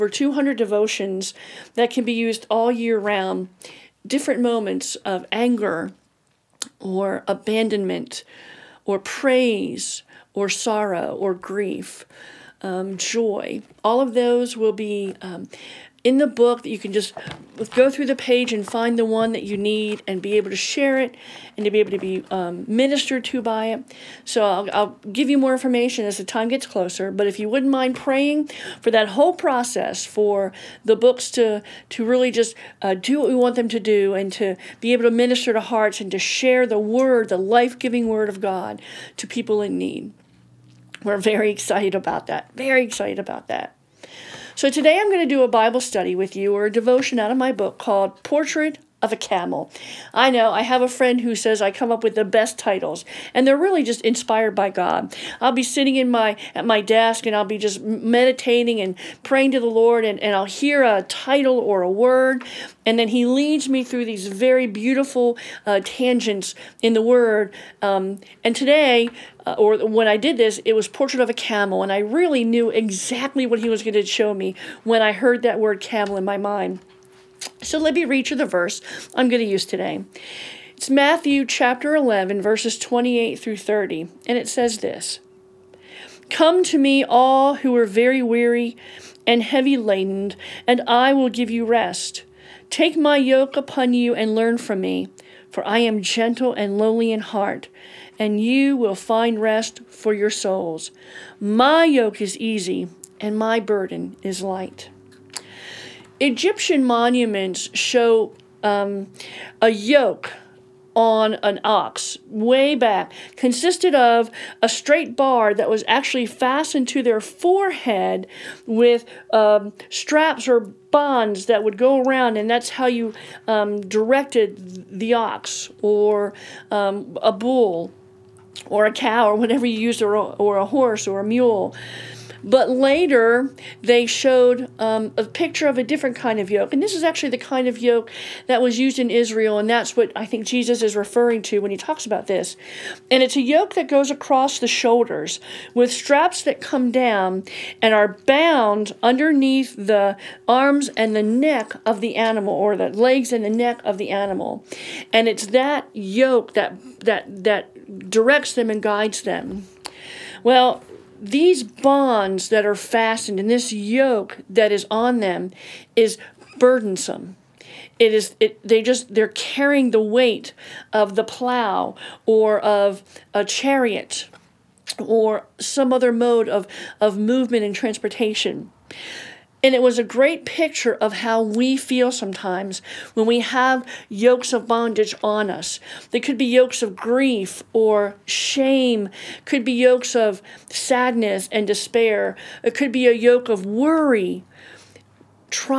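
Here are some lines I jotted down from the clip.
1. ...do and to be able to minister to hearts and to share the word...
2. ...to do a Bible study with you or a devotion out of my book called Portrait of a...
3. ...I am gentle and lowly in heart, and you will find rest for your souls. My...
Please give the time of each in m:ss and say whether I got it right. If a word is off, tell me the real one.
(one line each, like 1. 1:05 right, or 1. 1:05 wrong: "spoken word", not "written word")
1. 0:33 right
2. 0:45 right
3. 1:35 right.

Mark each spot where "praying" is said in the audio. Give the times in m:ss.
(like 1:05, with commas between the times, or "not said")
0:27, 0:59.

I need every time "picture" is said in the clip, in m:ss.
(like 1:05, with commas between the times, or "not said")
2:15, 3:00.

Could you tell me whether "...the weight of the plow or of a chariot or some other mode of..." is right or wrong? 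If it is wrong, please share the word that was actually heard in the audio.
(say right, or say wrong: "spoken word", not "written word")
right.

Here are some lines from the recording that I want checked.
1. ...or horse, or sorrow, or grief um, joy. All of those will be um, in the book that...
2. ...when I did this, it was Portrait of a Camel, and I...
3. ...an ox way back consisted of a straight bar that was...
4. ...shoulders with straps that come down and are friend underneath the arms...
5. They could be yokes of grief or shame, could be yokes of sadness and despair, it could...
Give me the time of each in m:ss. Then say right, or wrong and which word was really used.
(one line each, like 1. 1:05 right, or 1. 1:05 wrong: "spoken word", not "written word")
1. 0:08 wrong: "praise", not "horse"
2. 1:09 right
3. 1:51 right
4. 2:24 wrong: "bound", not "friend"
5. 3:06 right.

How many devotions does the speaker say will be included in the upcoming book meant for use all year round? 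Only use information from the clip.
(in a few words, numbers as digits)
200.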